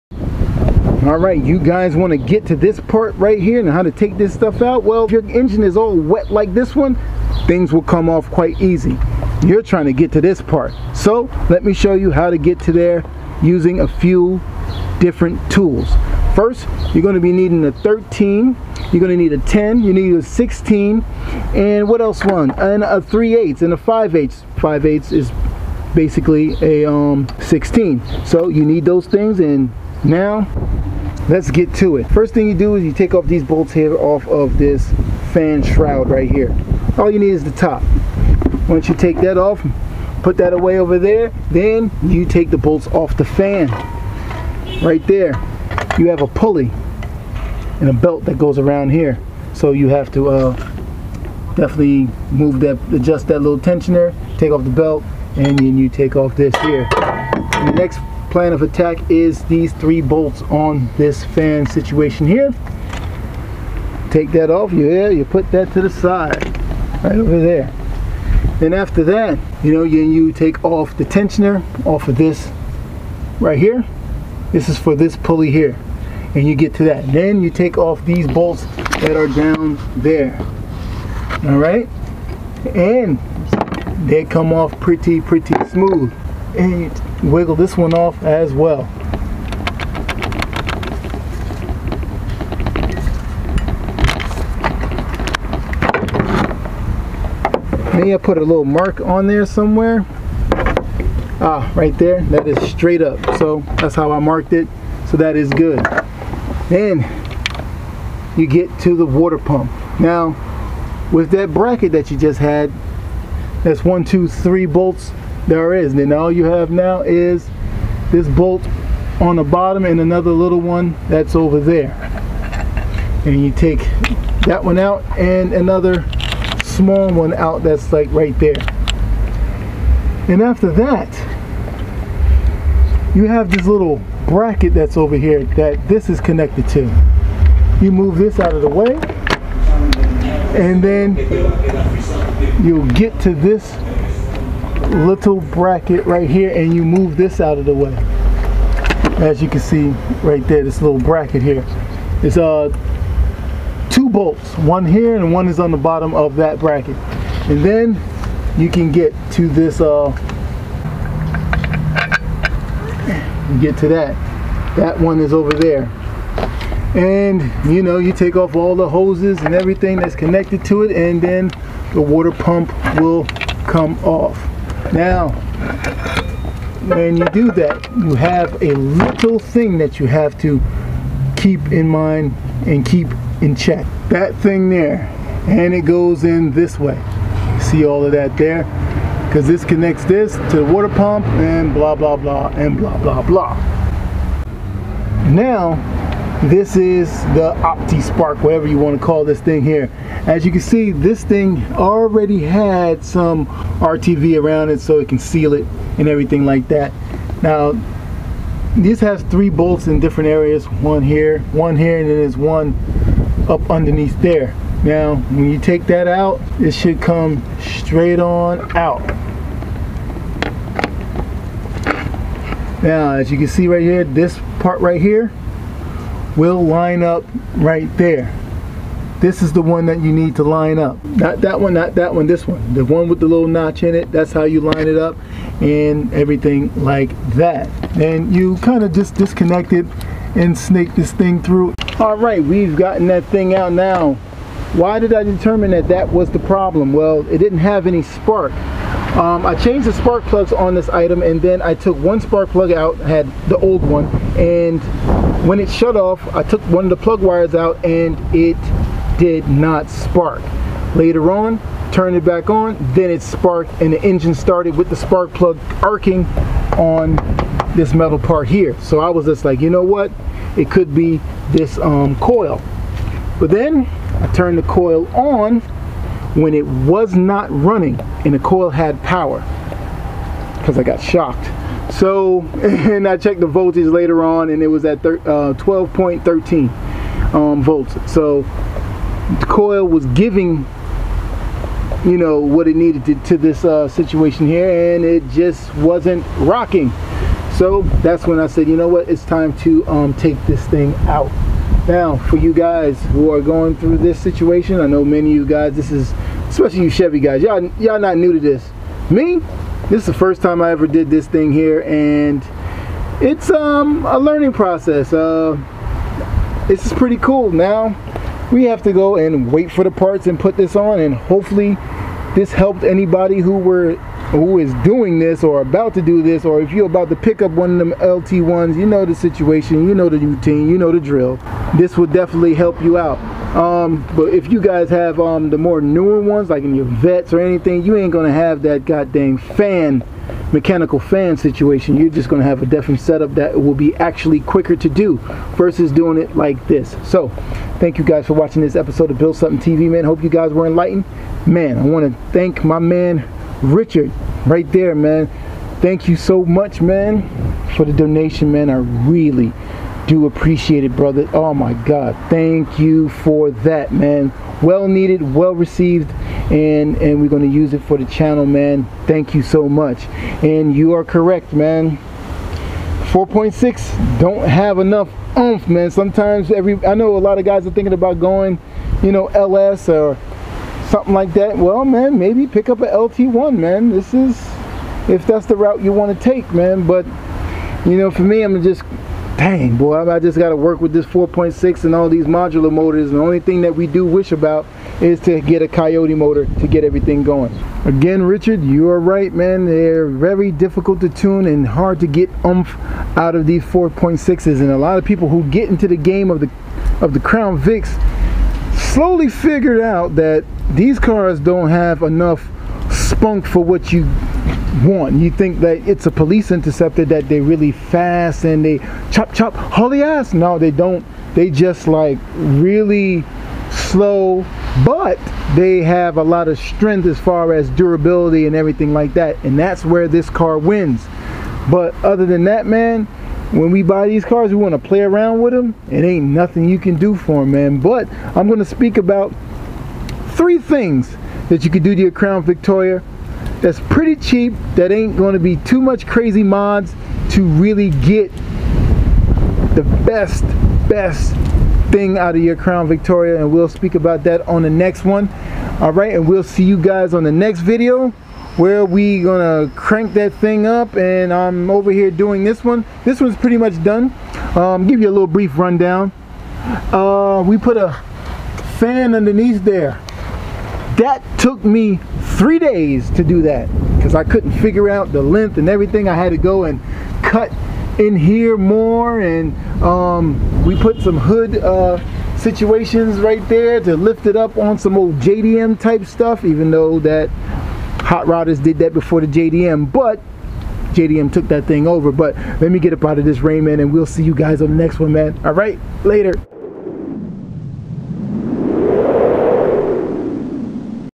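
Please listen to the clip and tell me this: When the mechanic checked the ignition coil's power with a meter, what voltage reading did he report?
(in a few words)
12.13 volts.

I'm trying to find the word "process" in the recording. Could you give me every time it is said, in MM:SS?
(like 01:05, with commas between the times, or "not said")
05:14.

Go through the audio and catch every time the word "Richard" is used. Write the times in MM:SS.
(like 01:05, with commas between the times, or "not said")
05:53, 06:38.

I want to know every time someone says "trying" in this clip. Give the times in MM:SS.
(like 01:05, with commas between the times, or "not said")
00:09.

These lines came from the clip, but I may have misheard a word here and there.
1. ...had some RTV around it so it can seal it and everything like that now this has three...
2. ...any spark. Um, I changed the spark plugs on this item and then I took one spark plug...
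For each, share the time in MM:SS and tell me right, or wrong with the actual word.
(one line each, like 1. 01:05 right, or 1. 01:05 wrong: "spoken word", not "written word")
1. 03:22 right
2. 04:07 right.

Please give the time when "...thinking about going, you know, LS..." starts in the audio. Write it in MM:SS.
06:17.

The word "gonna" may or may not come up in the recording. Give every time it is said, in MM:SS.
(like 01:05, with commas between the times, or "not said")
05:38, 05:42, 06:07, 07:39.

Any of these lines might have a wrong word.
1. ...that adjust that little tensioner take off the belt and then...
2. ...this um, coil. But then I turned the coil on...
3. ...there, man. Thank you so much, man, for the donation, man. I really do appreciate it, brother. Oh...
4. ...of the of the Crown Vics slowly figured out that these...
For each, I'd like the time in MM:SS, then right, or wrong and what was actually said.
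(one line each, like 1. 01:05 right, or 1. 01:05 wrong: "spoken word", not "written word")
1. 00:52 right
2. 04:31 right
3. 05:54 right
4. 06:46 right.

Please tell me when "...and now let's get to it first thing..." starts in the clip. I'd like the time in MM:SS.
00:29.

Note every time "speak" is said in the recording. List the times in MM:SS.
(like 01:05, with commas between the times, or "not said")
07:18, 07:33.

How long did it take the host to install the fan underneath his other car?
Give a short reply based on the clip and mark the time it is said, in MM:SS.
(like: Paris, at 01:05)
3 days, at 07:52.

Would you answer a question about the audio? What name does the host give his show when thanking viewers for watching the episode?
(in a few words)
Build Something TV.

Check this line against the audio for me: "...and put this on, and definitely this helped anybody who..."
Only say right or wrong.
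wrong.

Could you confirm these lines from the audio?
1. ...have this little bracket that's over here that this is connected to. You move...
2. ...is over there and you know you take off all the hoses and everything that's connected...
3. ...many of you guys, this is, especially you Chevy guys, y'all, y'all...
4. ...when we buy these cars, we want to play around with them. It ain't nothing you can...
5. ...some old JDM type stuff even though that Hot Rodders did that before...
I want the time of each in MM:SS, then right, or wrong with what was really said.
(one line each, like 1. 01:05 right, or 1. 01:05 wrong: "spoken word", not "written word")
1. 02:13 right
2. 02:45 right
3. 05:05 right
4. 07:13 right
5. 08:04 right.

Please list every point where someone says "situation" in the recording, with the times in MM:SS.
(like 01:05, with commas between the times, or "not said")
01:01, 04:53, 05:04, 05:29, 05:41, 08:02.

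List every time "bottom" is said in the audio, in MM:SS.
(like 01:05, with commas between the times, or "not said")
01:59, 02:35.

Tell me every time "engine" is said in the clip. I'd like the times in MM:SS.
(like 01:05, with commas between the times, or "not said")
00:05, 04:24.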